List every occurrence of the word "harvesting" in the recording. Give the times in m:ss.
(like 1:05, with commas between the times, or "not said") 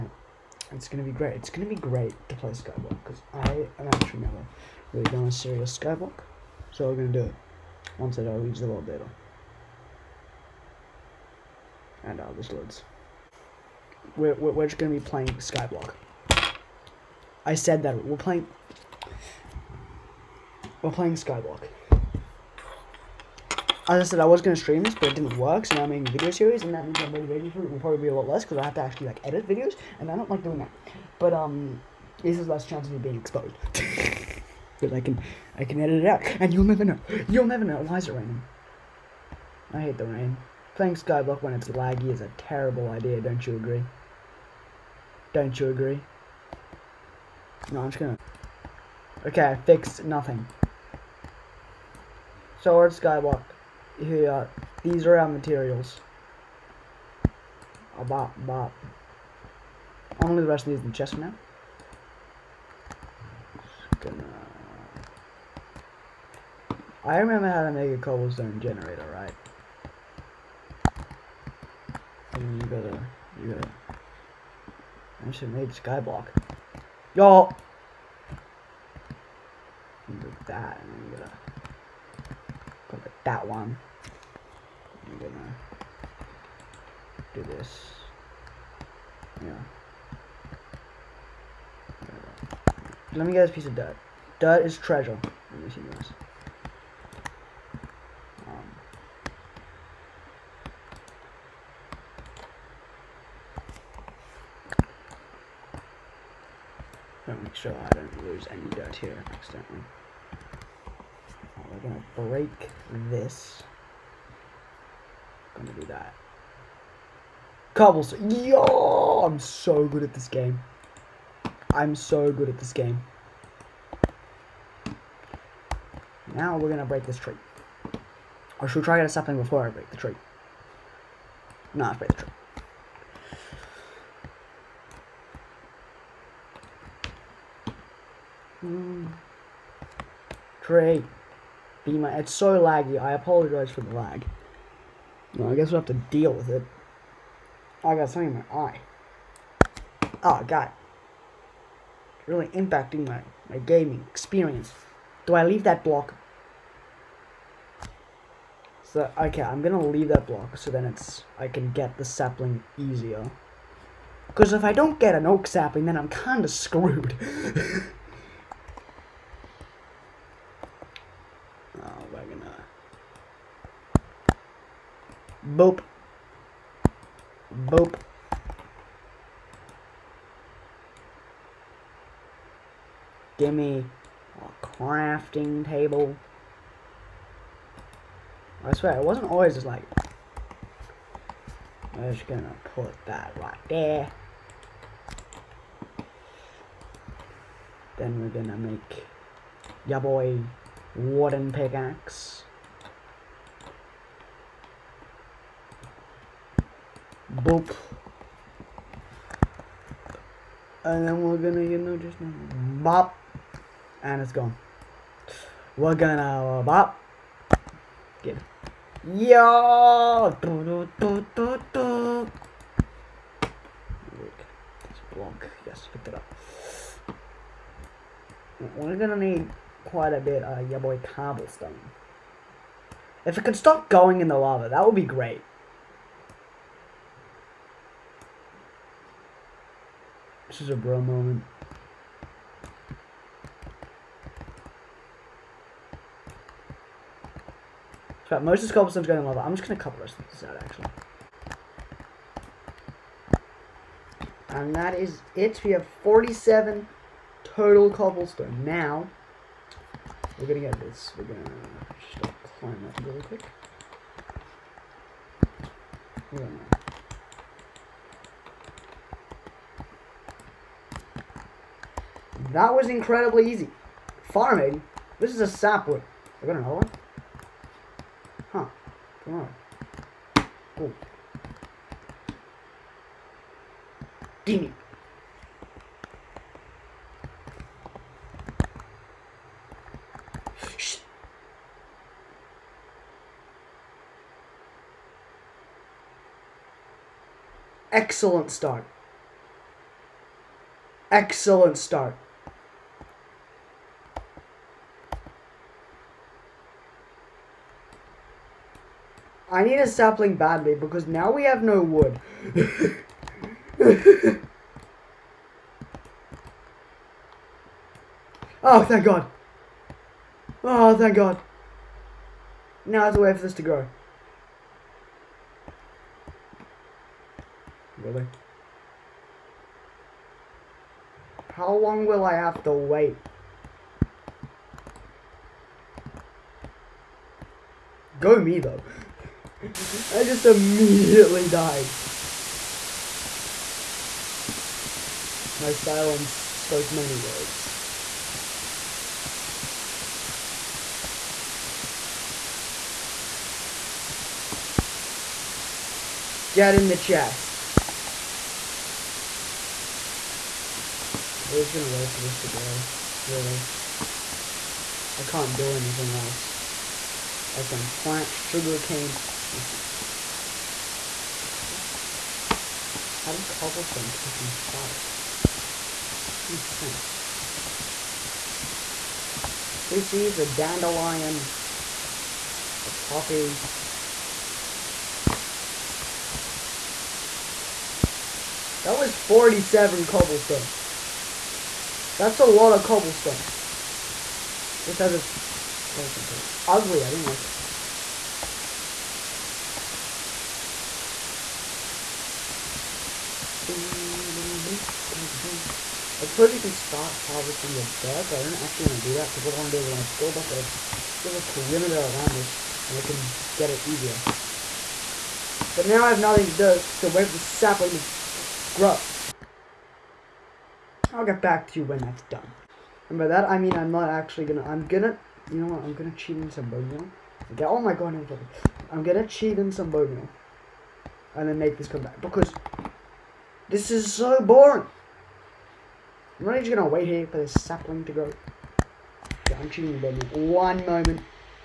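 6:47.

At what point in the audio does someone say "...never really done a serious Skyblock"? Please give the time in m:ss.
0:04.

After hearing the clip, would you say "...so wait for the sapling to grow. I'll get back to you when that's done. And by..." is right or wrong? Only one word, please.
right.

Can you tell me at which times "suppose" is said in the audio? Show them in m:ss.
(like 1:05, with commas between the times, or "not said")
6:46.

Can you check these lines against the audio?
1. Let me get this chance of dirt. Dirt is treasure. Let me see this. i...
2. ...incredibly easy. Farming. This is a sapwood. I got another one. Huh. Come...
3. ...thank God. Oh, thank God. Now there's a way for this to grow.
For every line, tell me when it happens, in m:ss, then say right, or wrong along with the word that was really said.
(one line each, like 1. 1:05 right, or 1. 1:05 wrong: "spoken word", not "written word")
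1. 1:33 wrong: "piece", not "chance"
2. 4:32 right
3. 5:18 right.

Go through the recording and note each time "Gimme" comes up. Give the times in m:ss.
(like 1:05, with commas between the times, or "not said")
4:44.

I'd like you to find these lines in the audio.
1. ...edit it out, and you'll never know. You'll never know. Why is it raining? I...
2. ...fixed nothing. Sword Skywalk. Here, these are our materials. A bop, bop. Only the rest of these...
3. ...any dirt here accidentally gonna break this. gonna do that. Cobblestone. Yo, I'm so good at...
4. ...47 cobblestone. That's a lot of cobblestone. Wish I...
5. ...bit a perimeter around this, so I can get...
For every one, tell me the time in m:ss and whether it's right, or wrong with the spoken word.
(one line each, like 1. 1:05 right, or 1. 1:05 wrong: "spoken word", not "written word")
1. 0:35 right
2. 0:49 right
3. 1:48 right
4. 6:29 right
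5. 6:51 right.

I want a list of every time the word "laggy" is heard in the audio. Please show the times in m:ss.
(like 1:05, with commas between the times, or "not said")
0:41, 2:22.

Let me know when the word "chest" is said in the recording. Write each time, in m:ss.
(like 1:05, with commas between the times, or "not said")
1:00, 5:56.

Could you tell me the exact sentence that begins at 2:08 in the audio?
Or should we try to get a sapling before I break the tree?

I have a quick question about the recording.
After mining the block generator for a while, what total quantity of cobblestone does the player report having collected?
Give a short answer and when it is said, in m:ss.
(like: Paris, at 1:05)
47, at 4:16.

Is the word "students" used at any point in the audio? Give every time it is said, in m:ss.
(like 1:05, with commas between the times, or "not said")
not said.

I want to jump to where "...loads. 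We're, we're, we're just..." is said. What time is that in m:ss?
0:12.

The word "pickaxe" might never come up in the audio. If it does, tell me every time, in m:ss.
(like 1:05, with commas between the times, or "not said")
3:21.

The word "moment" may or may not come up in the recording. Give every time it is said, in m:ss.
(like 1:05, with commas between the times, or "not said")
4:01, 7:20.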